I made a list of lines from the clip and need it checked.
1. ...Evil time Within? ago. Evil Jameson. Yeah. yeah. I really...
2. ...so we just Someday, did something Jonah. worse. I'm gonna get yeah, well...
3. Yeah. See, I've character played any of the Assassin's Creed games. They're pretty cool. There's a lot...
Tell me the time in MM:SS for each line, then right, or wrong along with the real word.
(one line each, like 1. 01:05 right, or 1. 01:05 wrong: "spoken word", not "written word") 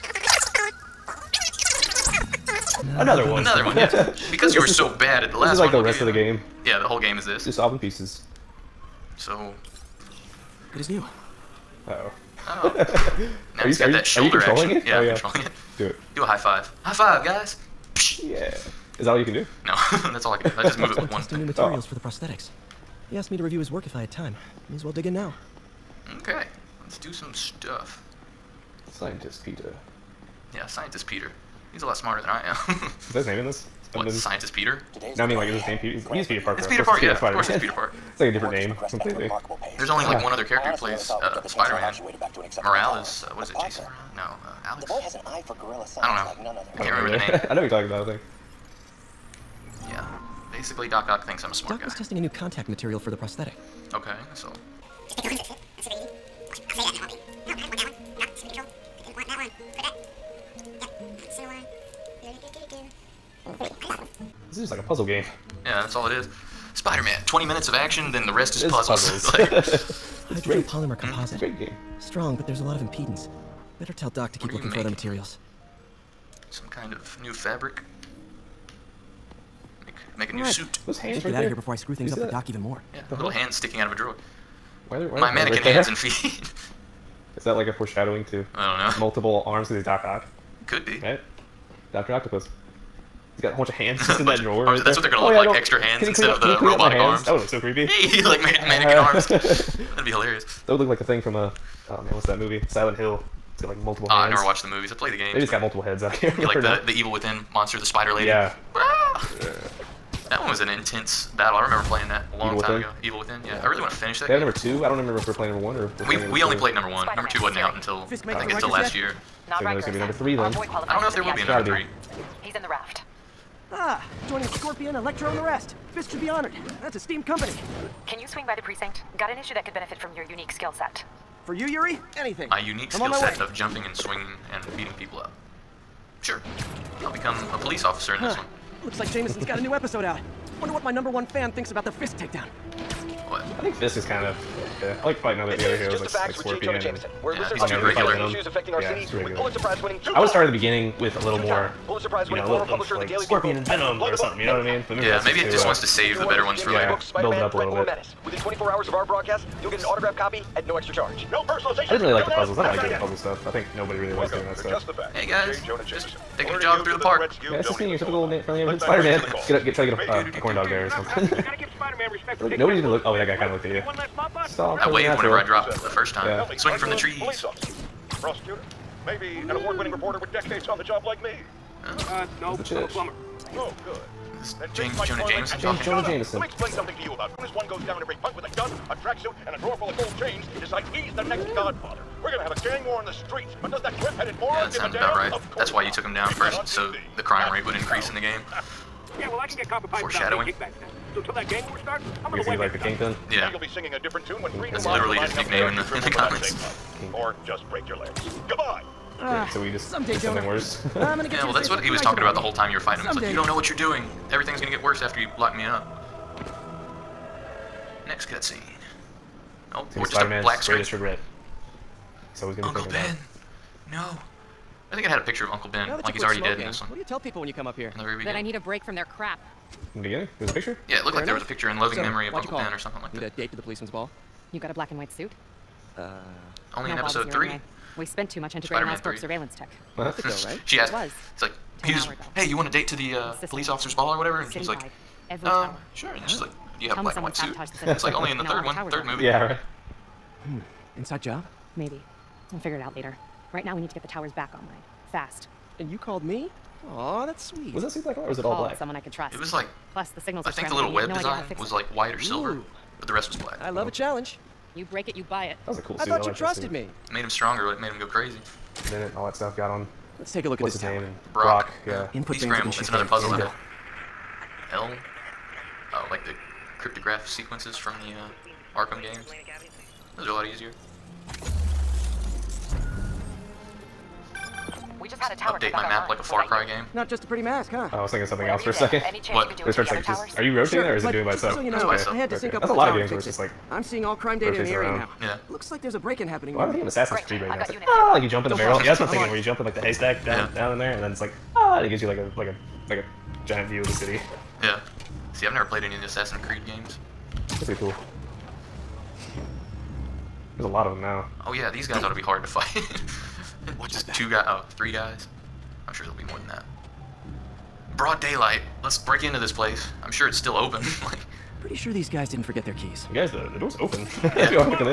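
1. 01:52 wrong: "Within", not "Jameson"
2. 03:29 right
3. 05:04 wrong: "never", not "character".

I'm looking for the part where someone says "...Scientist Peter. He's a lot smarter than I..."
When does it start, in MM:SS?
00:30.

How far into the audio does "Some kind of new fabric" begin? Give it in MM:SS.
01:16.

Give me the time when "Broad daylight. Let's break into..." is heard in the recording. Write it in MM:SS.
05:17.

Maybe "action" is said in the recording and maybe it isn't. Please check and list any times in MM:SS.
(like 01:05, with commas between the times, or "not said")
00:14, 01:07.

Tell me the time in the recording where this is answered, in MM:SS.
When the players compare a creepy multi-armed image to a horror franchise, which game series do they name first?
01:42.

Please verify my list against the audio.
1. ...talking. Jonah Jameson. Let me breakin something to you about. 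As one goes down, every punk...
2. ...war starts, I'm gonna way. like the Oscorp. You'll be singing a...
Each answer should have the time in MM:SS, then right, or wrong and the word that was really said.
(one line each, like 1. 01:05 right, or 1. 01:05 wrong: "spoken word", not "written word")
1. 03:05 wrong: "explain", not "breakin"
2. 03:21 wrong: "Yeah", not "Oscorp".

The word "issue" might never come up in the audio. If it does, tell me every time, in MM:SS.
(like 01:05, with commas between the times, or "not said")
02:09, 02:28.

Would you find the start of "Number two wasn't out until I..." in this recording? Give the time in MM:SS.
01:57.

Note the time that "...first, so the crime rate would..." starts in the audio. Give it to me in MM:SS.
03:16.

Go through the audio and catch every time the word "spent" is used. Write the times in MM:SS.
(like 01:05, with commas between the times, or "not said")
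03:58.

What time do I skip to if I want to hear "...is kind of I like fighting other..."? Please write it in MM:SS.
02:23.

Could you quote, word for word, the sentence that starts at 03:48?
That I need a break from their crap.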